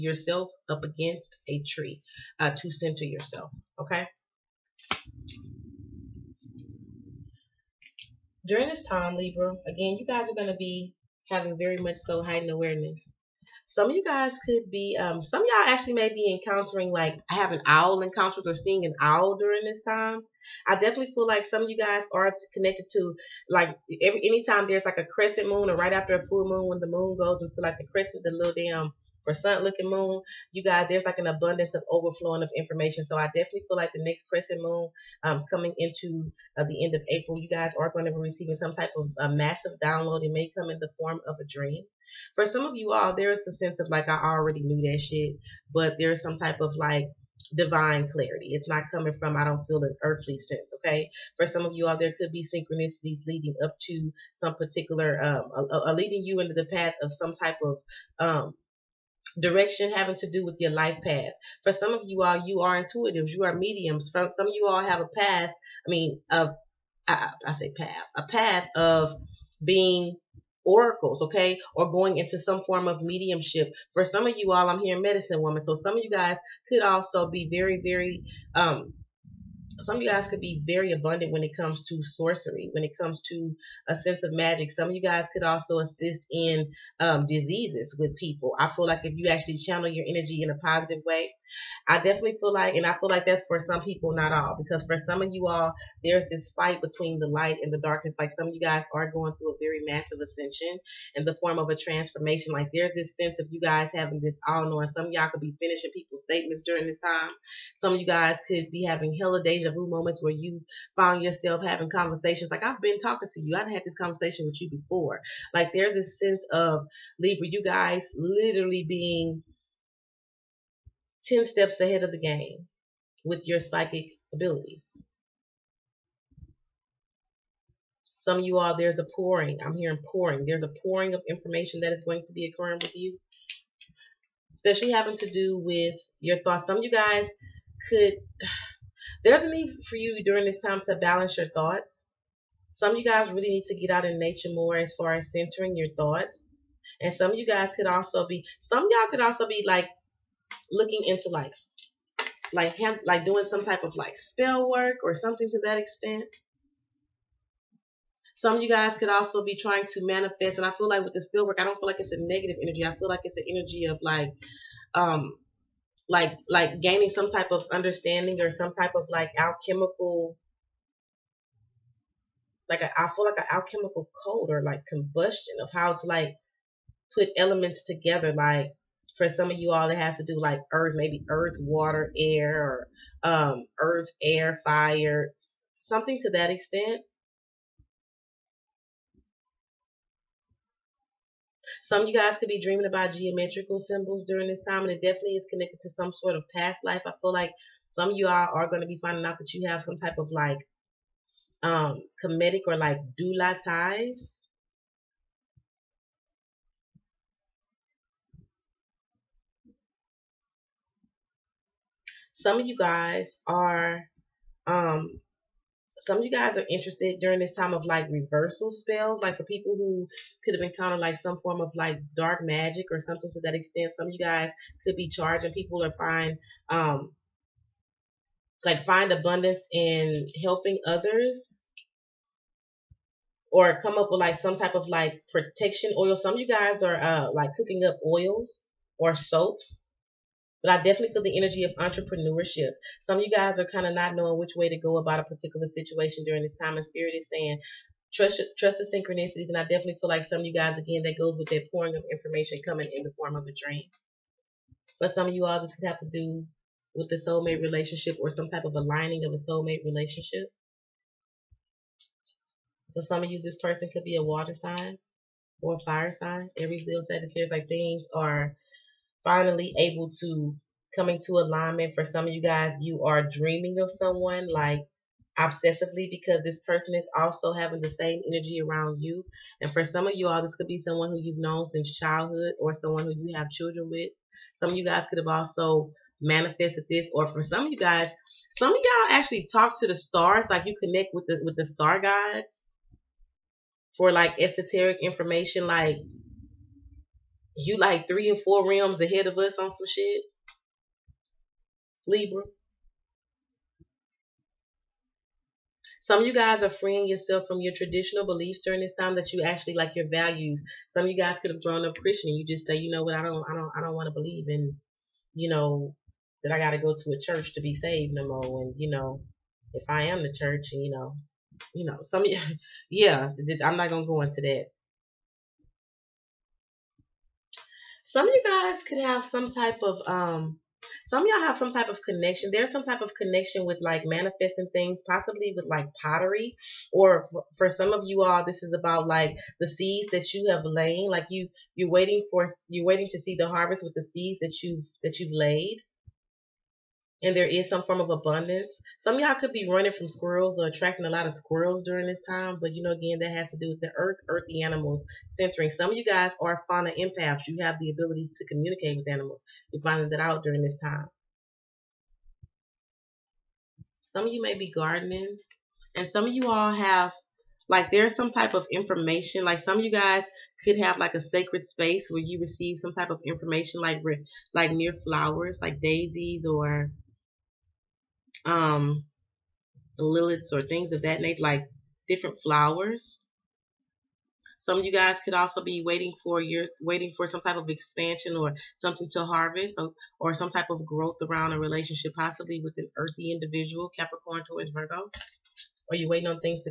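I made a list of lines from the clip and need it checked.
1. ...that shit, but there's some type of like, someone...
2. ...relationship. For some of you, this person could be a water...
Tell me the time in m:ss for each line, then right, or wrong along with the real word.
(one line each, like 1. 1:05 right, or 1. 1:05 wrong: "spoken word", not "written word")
1. 0:44 wrong: "divine", not "someone"
2. 4:19 right.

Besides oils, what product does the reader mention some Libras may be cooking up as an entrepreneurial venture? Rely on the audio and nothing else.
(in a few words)
Soaps.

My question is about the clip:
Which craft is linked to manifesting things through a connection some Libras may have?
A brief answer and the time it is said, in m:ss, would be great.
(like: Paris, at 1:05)
Pottery, at 5:36.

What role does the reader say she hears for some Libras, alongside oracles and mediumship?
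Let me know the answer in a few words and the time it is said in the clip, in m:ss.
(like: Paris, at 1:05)
Medicine woman, at 1:14.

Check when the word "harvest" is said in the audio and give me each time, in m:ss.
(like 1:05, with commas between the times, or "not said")
5:43, 6:29.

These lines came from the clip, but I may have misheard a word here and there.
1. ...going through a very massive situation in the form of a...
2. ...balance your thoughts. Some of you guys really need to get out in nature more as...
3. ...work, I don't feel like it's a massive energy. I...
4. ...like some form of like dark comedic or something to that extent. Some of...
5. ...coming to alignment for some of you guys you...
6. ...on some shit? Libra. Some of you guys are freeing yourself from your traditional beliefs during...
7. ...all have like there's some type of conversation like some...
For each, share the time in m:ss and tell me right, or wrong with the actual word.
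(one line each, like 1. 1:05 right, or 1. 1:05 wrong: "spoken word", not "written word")
1. 1:39 wrong: "ascension", not "situation"
2. 2:20 right
3. 2:41 wrong: "negative", not "massive"
4. 3:40 wrong: "magic", not "comedic"
5. 4:30 right
6. 4:59 right
7. 6:06 wrong: "information", not "conversation".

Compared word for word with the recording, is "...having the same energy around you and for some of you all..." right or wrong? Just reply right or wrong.
right.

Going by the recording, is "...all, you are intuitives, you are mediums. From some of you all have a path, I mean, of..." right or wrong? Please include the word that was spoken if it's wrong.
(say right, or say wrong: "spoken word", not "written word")
right.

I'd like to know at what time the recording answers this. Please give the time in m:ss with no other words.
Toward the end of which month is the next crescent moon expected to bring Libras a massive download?
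0:37.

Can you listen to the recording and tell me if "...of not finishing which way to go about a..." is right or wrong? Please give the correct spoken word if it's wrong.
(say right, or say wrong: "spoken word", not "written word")
wrong: "knowing", not "finishing".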